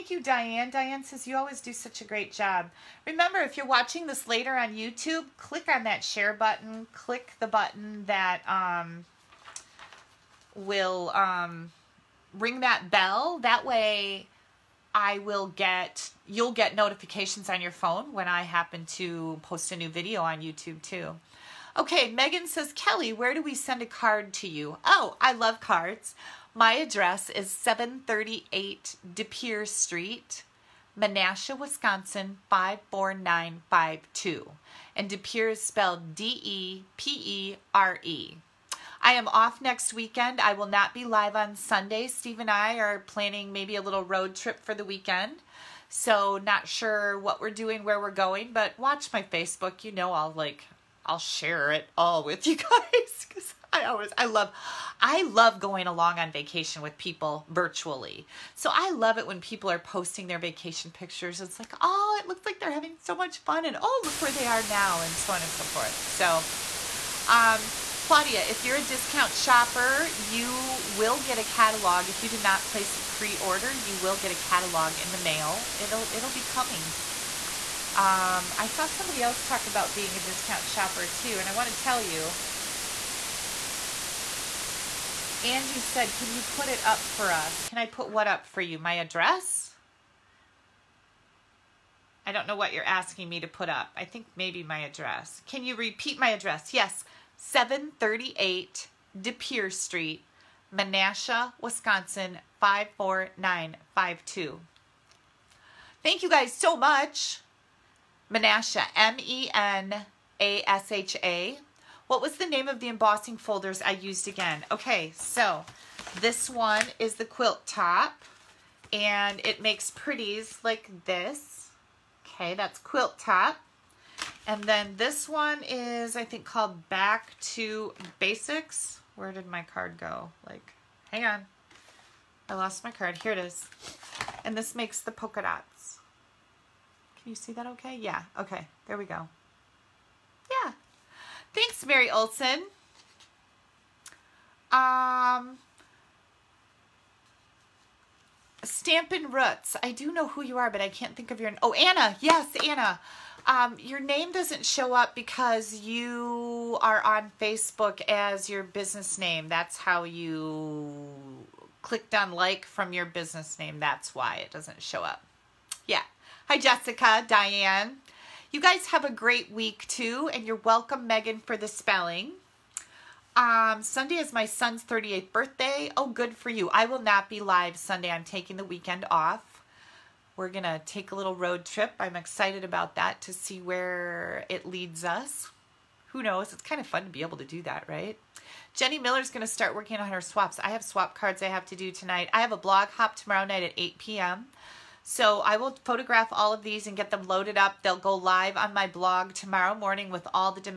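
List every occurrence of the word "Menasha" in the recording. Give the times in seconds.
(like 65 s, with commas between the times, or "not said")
30 s, 100 s, 108 s.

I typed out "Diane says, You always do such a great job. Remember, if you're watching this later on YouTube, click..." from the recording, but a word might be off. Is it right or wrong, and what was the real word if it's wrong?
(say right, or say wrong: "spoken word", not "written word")
right.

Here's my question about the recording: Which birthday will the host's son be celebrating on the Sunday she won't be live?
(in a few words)
38th.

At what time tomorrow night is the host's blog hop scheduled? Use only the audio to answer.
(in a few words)
8 p.m.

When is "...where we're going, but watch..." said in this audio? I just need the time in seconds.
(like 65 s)
47 s.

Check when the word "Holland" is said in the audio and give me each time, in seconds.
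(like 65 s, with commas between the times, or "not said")
not said.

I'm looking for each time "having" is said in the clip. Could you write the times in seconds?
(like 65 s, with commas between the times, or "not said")
62 s.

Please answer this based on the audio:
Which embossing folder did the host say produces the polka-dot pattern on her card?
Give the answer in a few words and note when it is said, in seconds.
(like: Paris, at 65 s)
Back to Basics, at 126 s.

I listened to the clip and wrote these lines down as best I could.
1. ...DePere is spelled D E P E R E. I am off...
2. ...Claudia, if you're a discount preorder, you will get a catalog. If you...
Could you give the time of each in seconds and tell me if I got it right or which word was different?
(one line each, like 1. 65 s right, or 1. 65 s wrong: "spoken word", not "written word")
1. 35 s right
2. 68 s wrong: "shopper", not "preorder".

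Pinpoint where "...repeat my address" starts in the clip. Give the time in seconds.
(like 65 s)
95 s.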